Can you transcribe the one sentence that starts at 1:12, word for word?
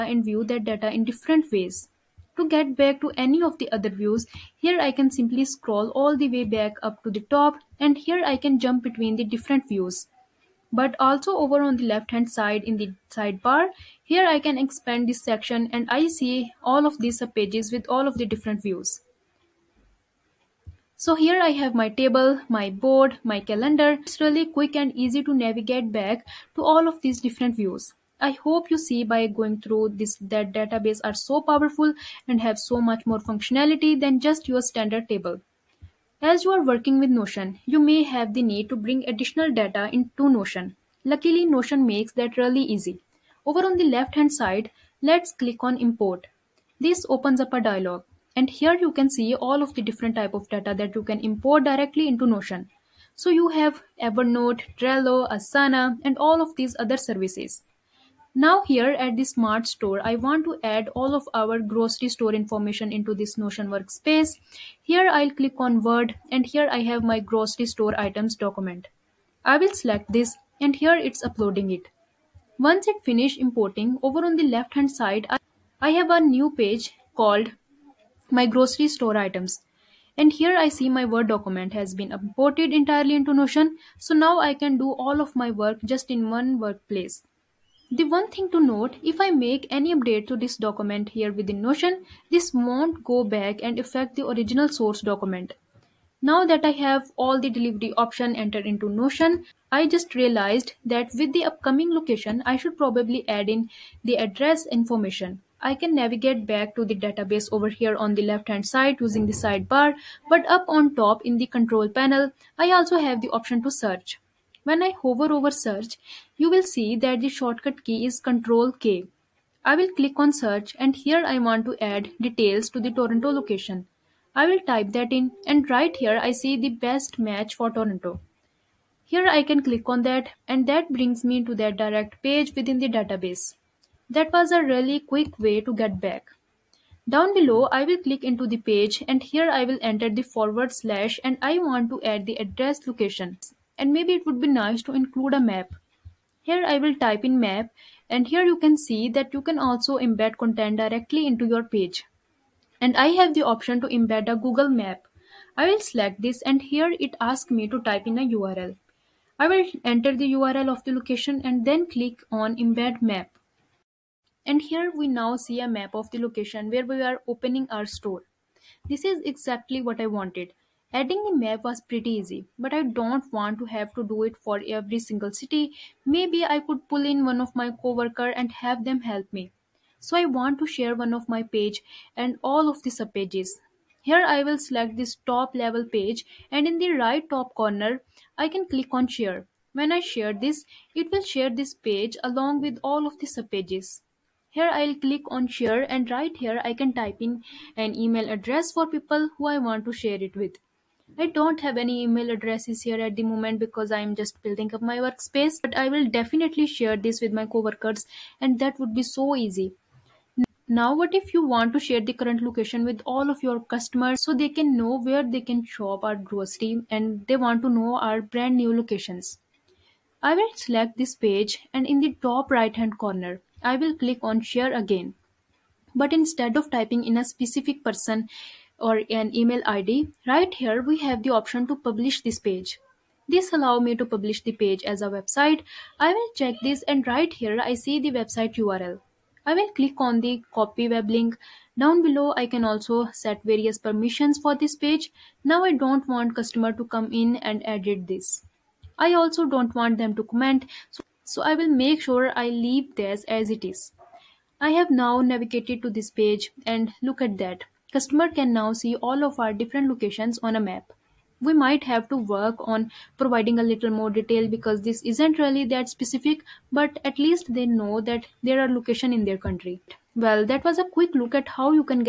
Once it finished importing, over on the left hand side, I have a new page called my grocery store items.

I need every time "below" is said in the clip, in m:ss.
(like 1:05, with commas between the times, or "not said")
2:17, 4:02.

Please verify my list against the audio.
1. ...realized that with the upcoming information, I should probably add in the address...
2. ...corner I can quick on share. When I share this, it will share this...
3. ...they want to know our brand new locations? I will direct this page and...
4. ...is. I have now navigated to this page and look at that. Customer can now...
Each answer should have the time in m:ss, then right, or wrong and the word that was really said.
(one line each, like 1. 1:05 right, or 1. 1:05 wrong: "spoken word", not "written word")
1. 1:40 wrong: "location", not "information"
2. 3:07 wrong: "click", not "quick"
3. 3:37 wrong: "select", not "direct"
4. 4:13 right.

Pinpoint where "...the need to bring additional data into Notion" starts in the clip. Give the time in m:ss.
0:38.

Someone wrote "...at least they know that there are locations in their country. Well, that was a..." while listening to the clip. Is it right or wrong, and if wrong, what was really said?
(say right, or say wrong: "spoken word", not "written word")
right.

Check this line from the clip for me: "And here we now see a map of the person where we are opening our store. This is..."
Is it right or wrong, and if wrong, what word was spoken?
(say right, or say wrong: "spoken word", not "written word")
wrong: "location", not "person".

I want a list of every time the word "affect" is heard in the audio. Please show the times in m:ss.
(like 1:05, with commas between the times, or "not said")
1:33.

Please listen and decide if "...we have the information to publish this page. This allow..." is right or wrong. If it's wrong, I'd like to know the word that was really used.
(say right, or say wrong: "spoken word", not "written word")
wrong: "option", not "information".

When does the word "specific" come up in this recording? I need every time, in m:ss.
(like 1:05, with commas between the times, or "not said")
3:47, 4:25.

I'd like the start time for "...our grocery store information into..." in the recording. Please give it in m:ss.
1:01.